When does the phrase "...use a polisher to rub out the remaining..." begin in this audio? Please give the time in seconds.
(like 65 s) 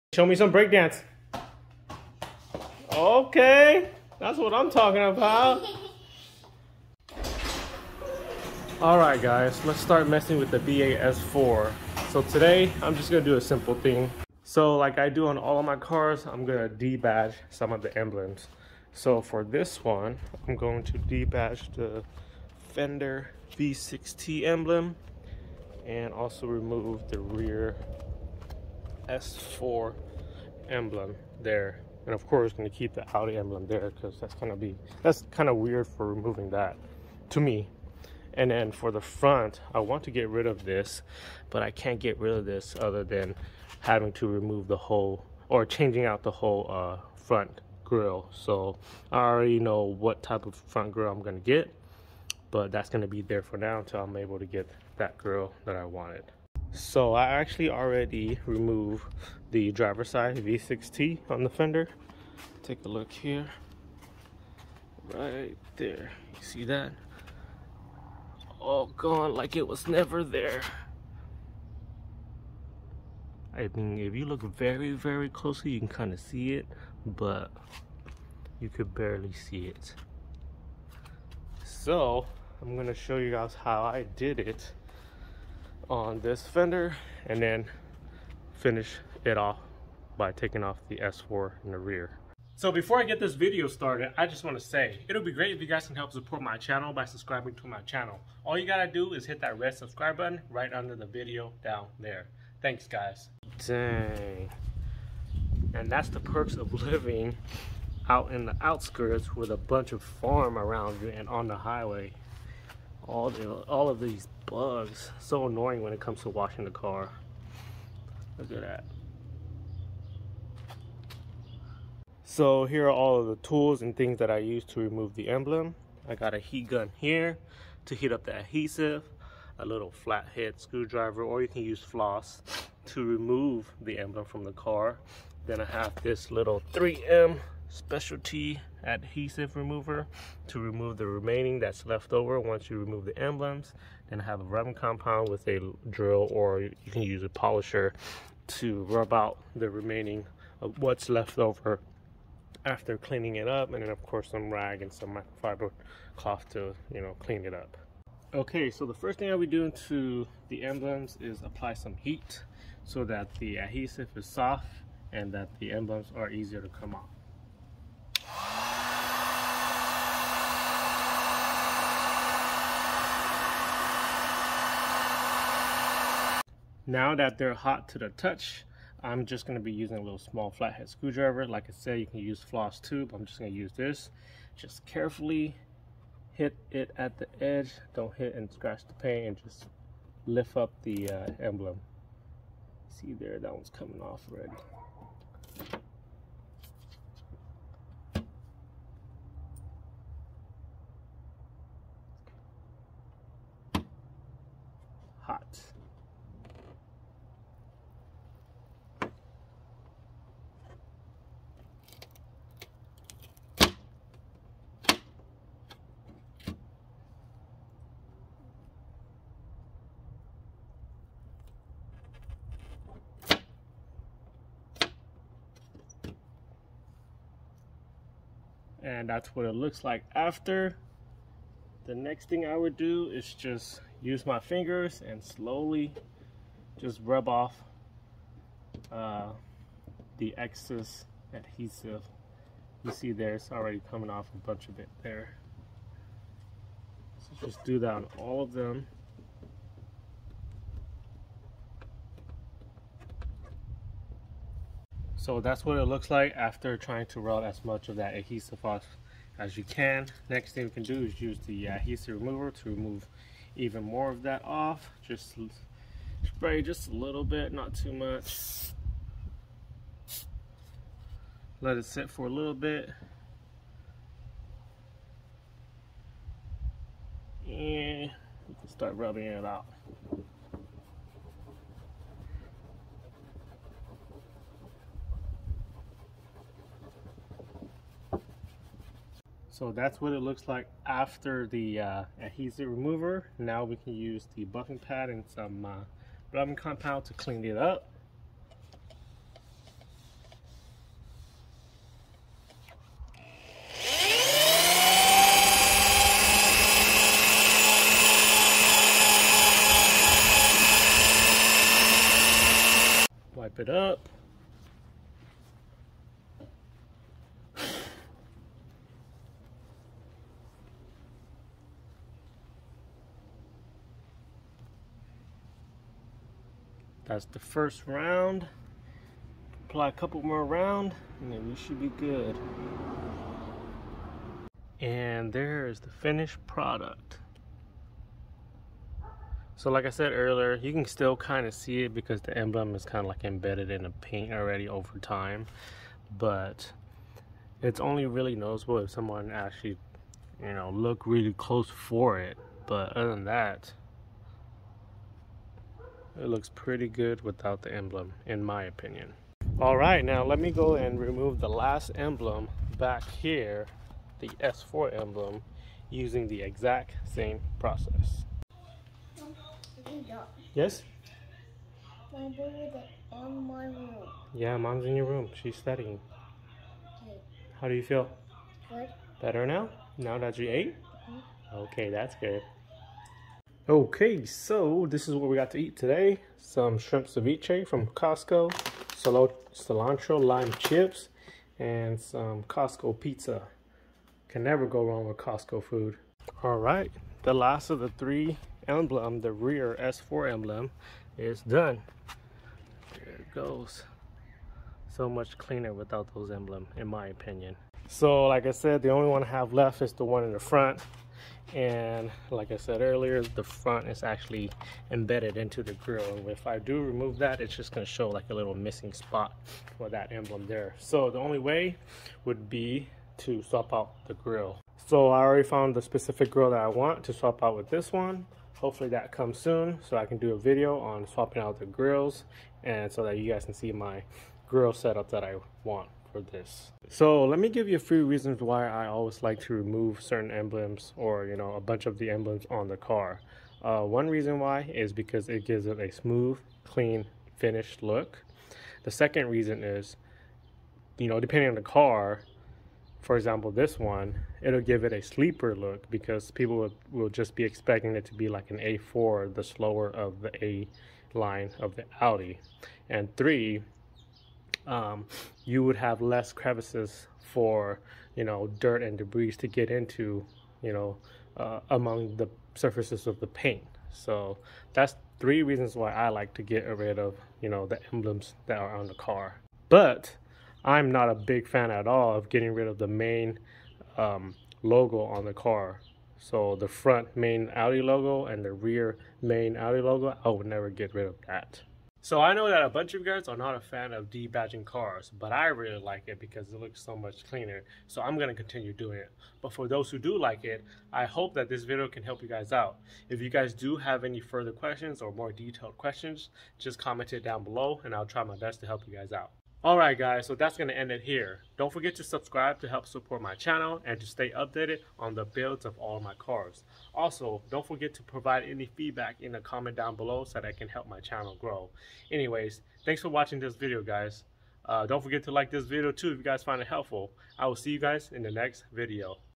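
147 s.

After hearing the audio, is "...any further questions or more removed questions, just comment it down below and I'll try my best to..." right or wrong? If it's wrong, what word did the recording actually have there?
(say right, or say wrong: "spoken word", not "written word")
wrong: "detailed", not "removed".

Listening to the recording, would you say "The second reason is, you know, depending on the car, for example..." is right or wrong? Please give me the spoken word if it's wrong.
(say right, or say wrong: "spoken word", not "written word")
right.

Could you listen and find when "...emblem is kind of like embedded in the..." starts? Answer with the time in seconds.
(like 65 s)
342 s.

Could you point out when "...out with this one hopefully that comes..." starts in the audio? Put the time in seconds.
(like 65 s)
427 s.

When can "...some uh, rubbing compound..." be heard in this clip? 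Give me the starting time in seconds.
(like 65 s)
295 s.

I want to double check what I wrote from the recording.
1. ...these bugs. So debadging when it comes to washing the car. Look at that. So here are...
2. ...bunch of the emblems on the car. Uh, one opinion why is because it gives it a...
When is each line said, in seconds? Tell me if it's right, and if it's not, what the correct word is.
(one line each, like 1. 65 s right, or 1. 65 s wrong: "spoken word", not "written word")
1. 113 s wrong: "annoying", not "debadging"
2. 441 s wrong: "reason", not "opinion".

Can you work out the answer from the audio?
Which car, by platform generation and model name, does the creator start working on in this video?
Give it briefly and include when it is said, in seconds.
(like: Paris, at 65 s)
B8 S4, at 10 s.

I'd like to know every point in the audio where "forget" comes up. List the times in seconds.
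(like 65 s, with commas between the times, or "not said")
511 s, 517 s, 525 s.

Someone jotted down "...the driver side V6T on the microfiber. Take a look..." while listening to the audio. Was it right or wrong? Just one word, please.
wrong.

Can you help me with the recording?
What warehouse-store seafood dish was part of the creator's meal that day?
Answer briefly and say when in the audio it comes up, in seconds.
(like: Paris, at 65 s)
Shrimp ceviche, at 386 s.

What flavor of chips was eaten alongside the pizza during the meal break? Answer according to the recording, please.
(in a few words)
Cilantro lime.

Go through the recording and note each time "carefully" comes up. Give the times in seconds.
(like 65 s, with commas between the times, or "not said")
184 s.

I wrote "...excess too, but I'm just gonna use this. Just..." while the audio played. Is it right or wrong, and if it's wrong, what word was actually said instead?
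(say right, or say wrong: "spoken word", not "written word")
wrong: "floss", not "excess".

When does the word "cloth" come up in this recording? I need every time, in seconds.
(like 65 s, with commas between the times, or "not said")
156 s.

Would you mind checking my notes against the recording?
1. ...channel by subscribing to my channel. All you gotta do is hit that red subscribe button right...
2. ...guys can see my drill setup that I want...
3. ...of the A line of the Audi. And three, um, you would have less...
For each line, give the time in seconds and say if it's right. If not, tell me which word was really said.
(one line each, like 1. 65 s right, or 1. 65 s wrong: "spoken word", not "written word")
1. 96 s right
2. 433 s wrong: "grill", not "drill"
3. 459 s right.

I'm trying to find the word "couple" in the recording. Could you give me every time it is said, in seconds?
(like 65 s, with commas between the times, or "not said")
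329 s.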